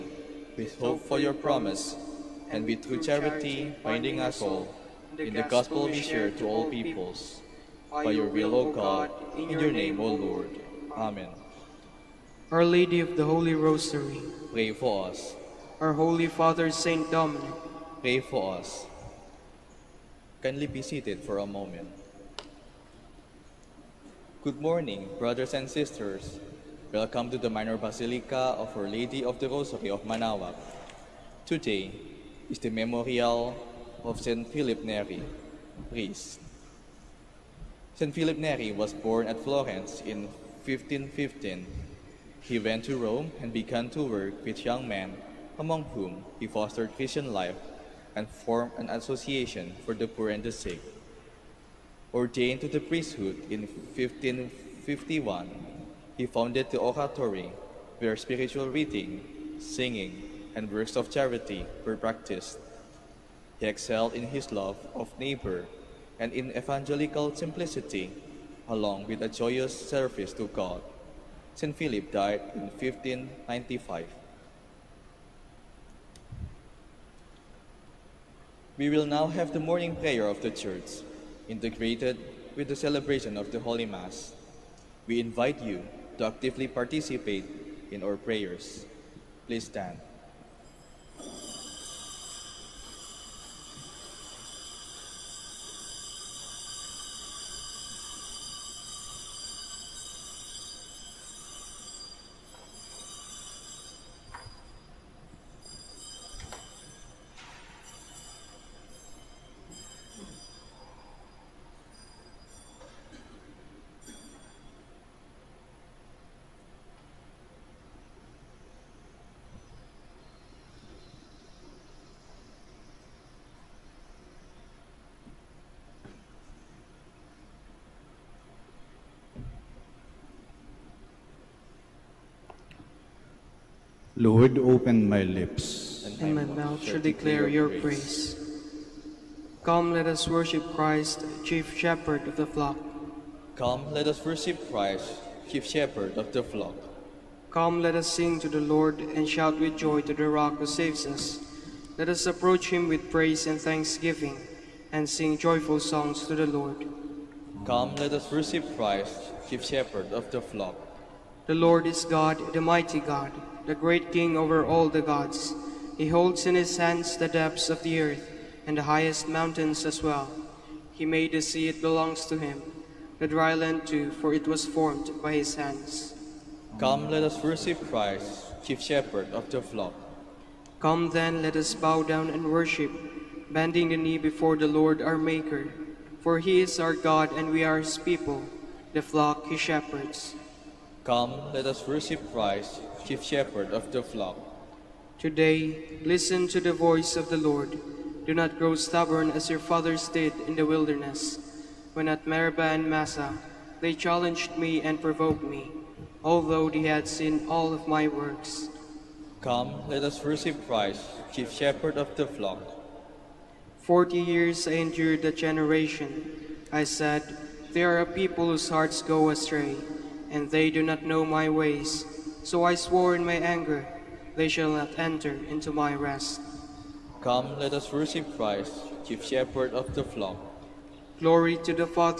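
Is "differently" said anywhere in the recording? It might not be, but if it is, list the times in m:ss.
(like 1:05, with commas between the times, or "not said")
not said.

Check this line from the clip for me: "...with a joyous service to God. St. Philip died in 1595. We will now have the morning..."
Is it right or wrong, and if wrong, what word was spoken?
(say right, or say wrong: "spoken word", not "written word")
right.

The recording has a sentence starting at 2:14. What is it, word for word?
Lord, open my lips, and my mouth shall declare your praise.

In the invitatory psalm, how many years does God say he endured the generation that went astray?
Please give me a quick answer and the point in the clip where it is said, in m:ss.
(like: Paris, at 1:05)
40, at 3:33.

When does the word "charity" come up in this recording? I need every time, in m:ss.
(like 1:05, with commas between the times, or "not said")
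0:03, 1:01.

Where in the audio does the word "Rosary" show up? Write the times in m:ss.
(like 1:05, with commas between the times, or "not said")
0:13, 0:29.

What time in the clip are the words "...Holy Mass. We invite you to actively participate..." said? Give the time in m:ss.
1:23.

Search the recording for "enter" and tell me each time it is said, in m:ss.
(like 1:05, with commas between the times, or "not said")
3:44.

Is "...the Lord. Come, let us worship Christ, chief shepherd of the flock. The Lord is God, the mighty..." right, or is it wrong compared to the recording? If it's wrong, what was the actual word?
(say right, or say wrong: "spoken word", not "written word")
right.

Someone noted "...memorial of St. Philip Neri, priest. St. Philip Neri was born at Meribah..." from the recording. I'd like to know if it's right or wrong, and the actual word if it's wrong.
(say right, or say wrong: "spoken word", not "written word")
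wrong: "Florence", not "Meribah".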